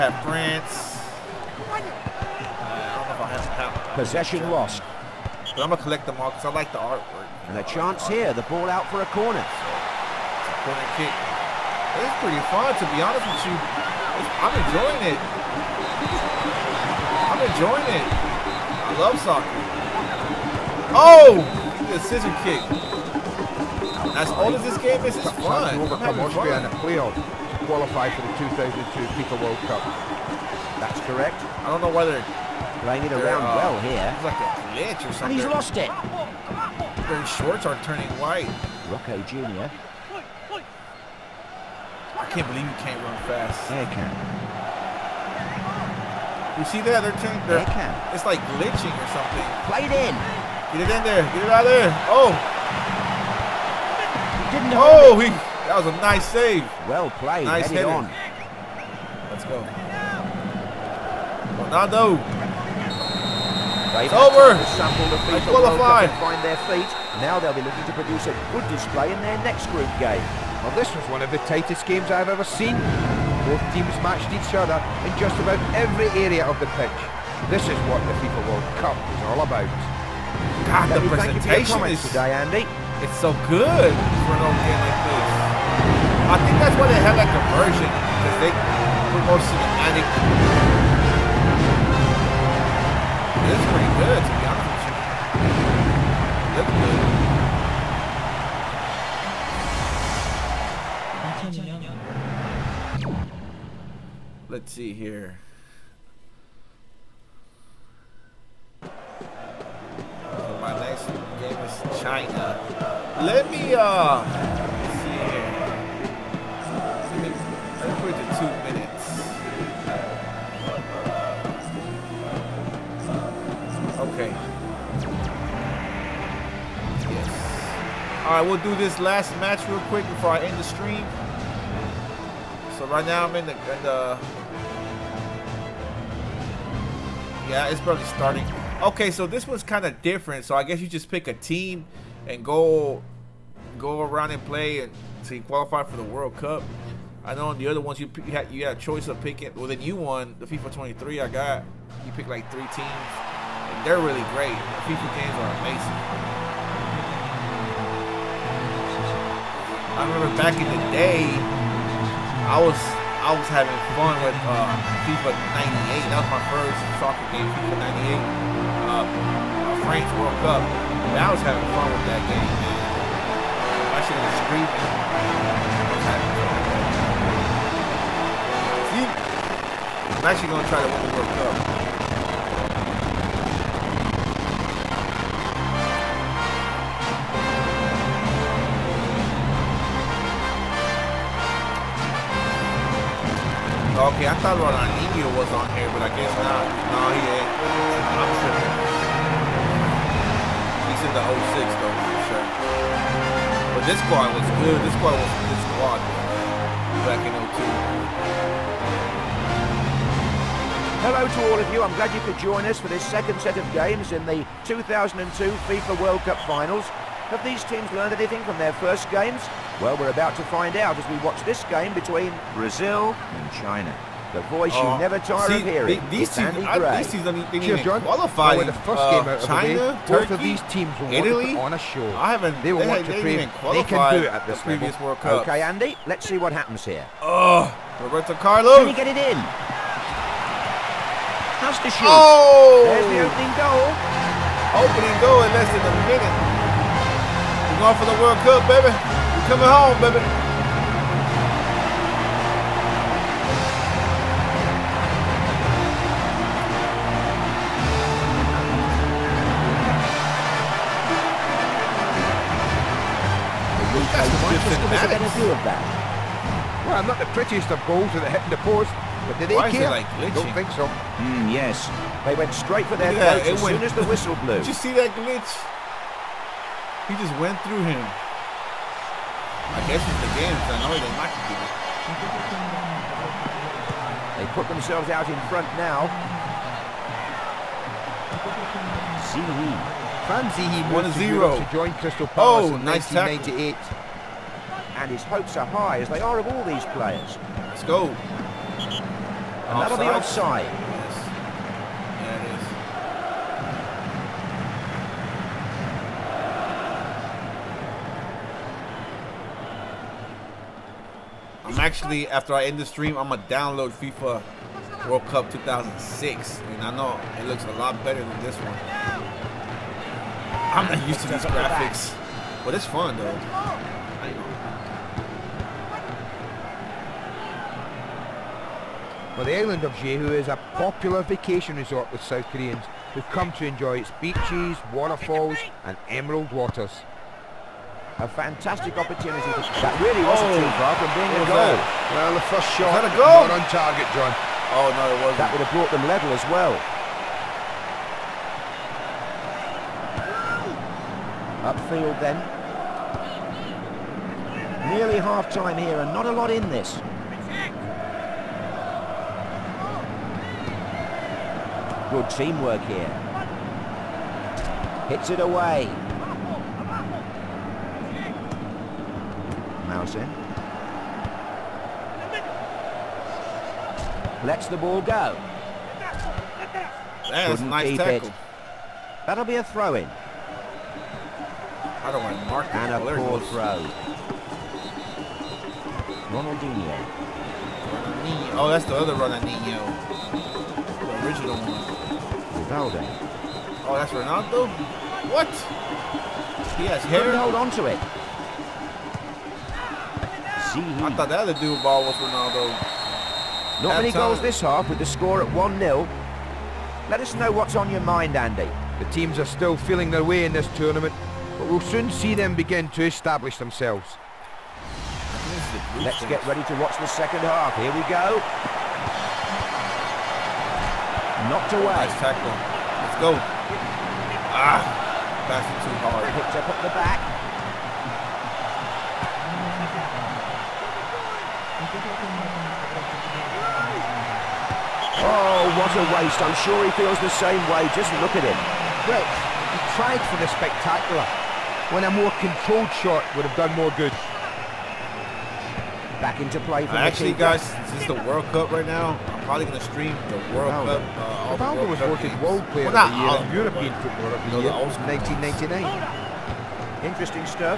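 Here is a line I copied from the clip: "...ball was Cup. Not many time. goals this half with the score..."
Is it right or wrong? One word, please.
wrong.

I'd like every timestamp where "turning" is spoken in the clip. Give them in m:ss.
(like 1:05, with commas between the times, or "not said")
0:37, 0:47.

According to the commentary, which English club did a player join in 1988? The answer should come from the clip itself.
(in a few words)
Crystal Palace.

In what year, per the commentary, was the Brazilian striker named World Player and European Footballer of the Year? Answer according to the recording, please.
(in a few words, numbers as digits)
1999.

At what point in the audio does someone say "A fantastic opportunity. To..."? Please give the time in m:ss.
5:38.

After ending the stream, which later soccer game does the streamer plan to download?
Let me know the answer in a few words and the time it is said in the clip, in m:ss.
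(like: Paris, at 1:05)
FIFA World Cup 2006, at 5:13.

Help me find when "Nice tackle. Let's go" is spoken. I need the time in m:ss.
7:02.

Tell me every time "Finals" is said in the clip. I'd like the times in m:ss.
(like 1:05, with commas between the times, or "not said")
3:36.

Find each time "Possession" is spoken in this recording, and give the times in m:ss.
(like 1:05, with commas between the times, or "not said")
0:03.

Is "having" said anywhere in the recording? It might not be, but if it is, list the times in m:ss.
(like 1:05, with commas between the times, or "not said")
0:26, 2:43, 2:51.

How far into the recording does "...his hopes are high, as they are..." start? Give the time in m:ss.
4:55.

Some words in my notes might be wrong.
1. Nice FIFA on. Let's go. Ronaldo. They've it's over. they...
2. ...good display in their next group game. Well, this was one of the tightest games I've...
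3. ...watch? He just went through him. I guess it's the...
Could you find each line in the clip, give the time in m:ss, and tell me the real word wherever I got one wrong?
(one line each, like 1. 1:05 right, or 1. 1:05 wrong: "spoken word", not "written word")
1. 0:57 wrong: "Head", not "FIFA"
2. 1:08 right
3. 4:35 wrong: "glitch", not "watch".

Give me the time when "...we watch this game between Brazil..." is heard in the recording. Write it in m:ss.
3:41.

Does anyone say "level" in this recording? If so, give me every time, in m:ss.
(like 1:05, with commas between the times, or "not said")
3:54, 5:46.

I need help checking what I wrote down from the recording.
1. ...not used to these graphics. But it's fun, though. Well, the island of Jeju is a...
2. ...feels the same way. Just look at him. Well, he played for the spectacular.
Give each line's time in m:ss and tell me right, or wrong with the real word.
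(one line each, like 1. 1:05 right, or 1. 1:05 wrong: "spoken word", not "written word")
1. 5:20 right
2. 7:16 wrong: "tried", not "played".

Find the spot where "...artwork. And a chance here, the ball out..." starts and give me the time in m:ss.
0:06.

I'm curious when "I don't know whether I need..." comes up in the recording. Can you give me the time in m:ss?
0:31.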